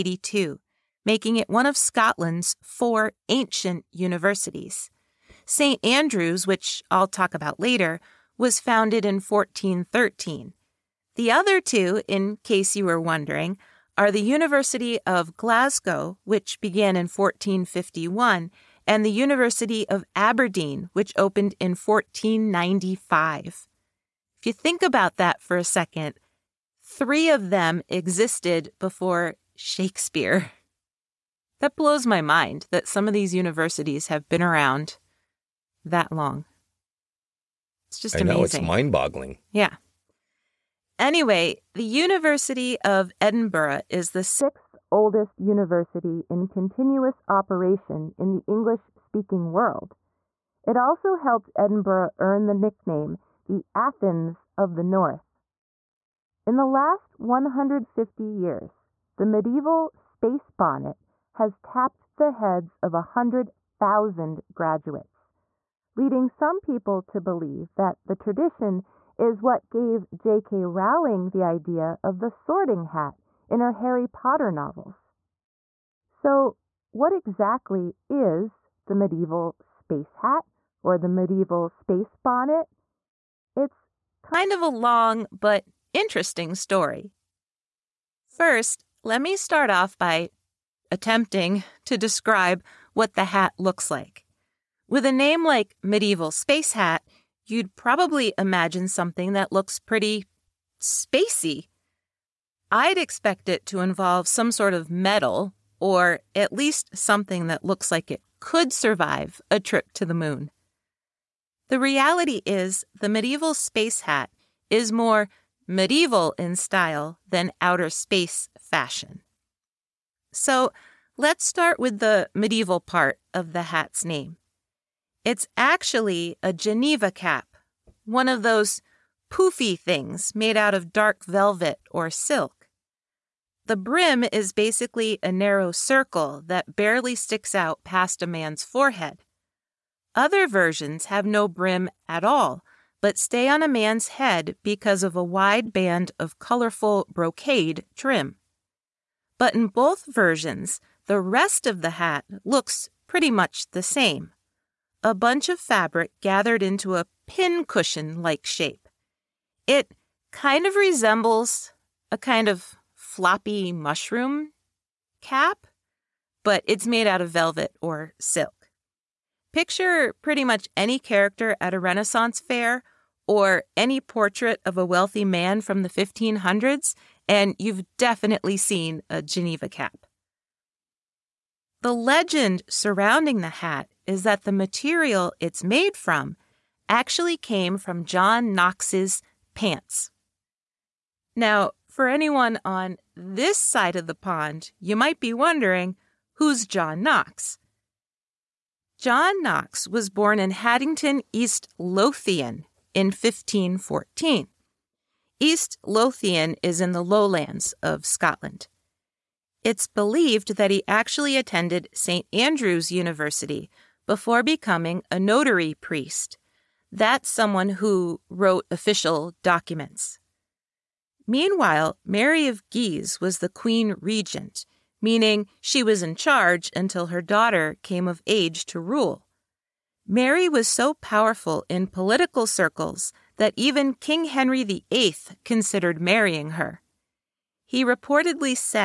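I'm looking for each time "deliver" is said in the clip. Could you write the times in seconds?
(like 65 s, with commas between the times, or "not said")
not said.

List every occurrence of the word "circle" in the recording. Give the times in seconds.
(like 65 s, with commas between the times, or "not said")
135 s, 232 s.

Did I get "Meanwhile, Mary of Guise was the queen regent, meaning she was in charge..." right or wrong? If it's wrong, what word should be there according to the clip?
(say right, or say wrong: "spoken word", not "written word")
right.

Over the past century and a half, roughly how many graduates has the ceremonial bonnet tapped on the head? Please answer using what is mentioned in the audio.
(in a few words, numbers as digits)
100,000.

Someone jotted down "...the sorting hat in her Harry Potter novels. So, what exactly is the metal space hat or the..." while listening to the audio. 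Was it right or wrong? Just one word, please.
wrong.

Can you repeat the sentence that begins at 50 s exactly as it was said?
It also helped Edinburgh earn the nickname the Athens of the North.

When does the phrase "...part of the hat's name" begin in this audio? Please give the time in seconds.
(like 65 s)
122 s.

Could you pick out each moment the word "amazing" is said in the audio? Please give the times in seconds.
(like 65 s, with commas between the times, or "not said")
38 s.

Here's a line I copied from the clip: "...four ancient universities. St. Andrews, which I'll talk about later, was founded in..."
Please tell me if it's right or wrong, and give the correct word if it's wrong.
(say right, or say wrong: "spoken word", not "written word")
right.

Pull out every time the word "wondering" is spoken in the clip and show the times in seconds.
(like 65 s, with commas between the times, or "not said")
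13 s, 195 s.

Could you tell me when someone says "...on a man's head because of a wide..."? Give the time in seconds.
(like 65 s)
143 s.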